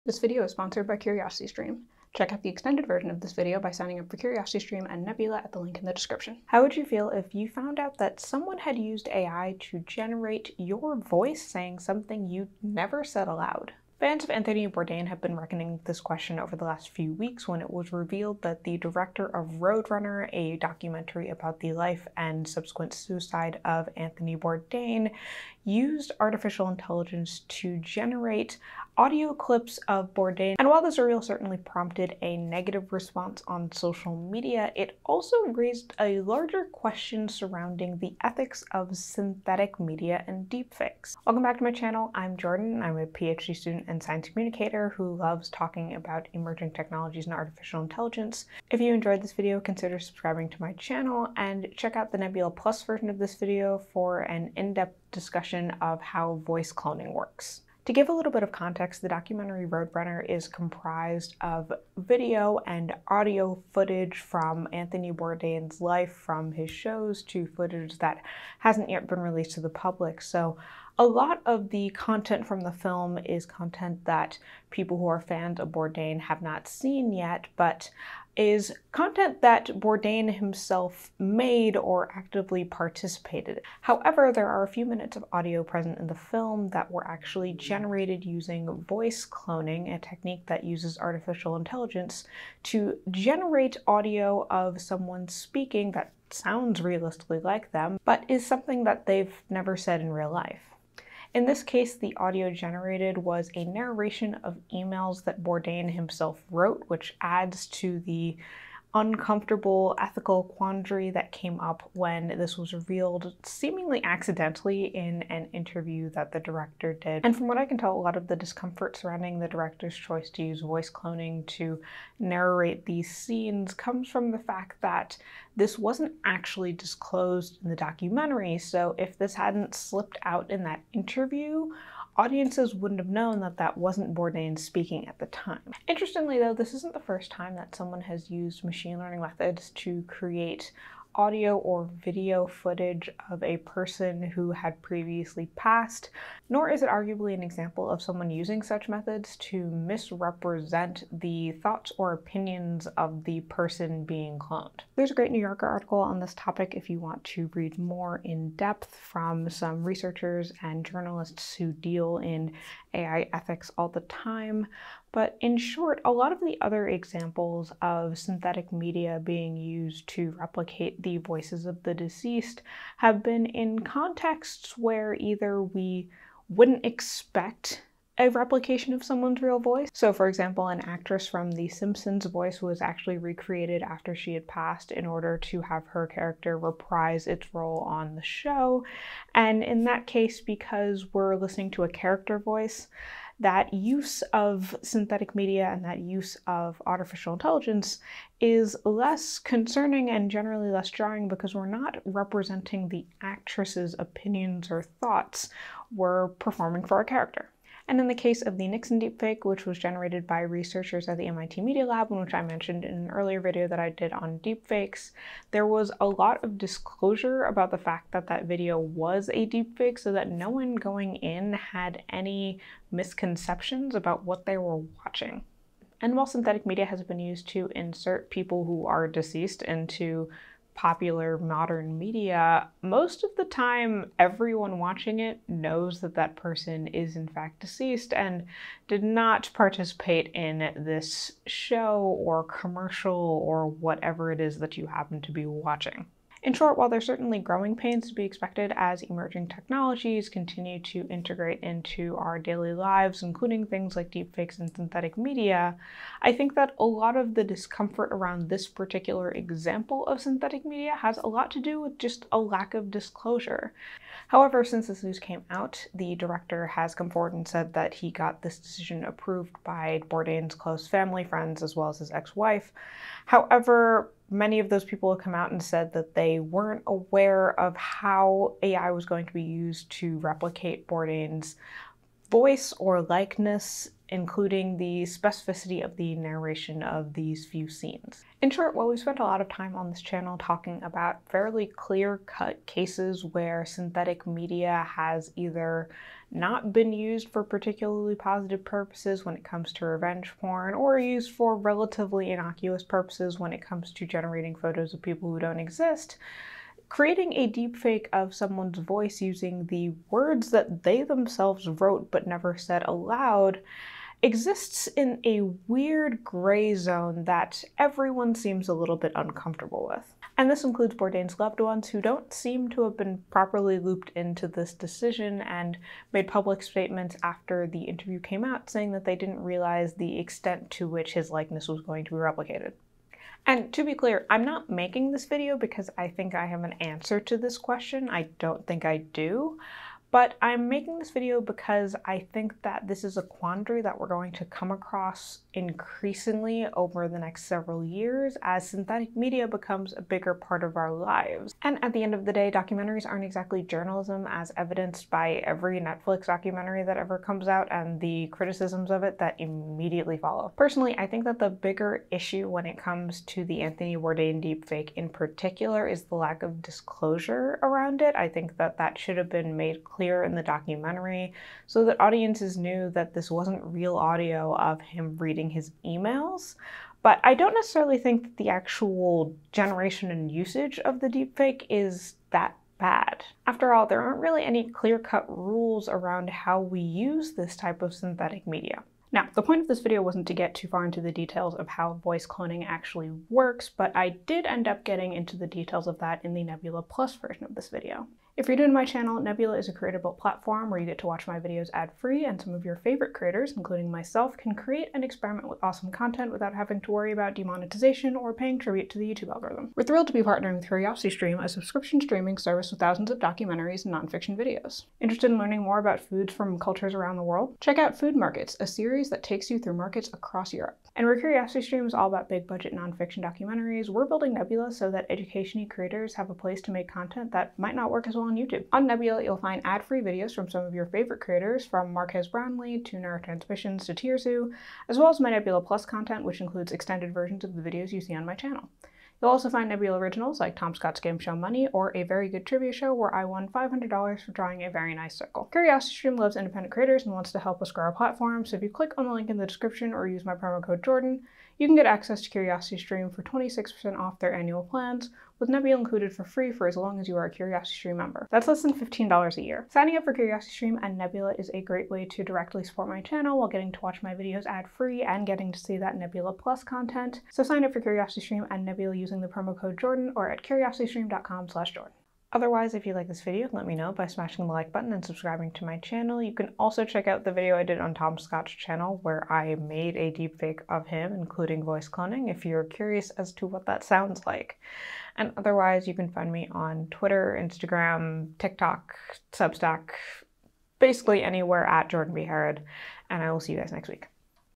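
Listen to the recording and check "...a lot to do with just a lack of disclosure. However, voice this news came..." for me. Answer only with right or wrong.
wrong.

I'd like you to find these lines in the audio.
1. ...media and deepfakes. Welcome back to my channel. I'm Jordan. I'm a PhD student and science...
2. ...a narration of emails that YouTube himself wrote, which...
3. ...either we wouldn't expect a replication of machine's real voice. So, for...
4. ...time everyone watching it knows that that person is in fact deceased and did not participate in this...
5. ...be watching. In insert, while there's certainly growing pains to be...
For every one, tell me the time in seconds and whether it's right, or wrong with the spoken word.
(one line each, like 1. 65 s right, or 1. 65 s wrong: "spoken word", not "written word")
1. 39 s right
2. 103 s wrong: "Bourdain", not "YouTube"
3. 175 s wrong: "someone", not "machine"
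4. 233 s right
5. 245 s wrong: "short", not "insert".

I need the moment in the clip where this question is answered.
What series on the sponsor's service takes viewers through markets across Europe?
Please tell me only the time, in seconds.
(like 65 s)
417 s.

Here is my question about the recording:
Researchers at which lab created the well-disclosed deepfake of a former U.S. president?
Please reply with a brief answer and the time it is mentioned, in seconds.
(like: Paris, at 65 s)
MIT Media Lab, at 211 s.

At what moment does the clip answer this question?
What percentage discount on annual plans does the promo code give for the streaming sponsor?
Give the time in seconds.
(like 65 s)
453 s.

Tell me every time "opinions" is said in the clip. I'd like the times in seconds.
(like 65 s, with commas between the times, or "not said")
152 s, 203 s.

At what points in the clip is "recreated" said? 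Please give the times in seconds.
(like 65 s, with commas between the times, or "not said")
183 s.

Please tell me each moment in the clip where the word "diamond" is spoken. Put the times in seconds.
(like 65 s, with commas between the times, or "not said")
not said.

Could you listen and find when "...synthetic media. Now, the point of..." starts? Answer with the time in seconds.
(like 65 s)
387 s.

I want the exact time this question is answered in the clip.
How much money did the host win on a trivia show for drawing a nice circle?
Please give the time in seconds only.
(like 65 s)
443 s.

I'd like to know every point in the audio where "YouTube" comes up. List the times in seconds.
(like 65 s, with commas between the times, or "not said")
409 s, 428 s.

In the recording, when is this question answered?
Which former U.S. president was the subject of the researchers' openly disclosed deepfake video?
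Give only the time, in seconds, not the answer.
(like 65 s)
208 s.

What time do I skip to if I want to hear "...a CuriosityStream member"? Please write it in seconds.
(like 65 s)
457 s.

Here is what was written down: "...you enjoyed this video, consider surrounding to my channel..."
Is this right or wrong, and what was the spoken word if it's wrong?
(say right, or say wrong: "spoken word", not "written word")
wrong: "subscribing", not "surrounding".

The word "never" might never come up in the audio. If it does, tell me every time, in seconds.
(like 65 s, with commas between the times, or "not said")
12 s, 99 s, 312 s.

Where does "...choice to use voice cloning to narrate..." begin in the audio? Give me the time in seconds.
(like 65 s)
119 s.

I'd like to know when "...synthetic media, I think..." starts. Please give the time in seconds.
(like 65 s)
254 s.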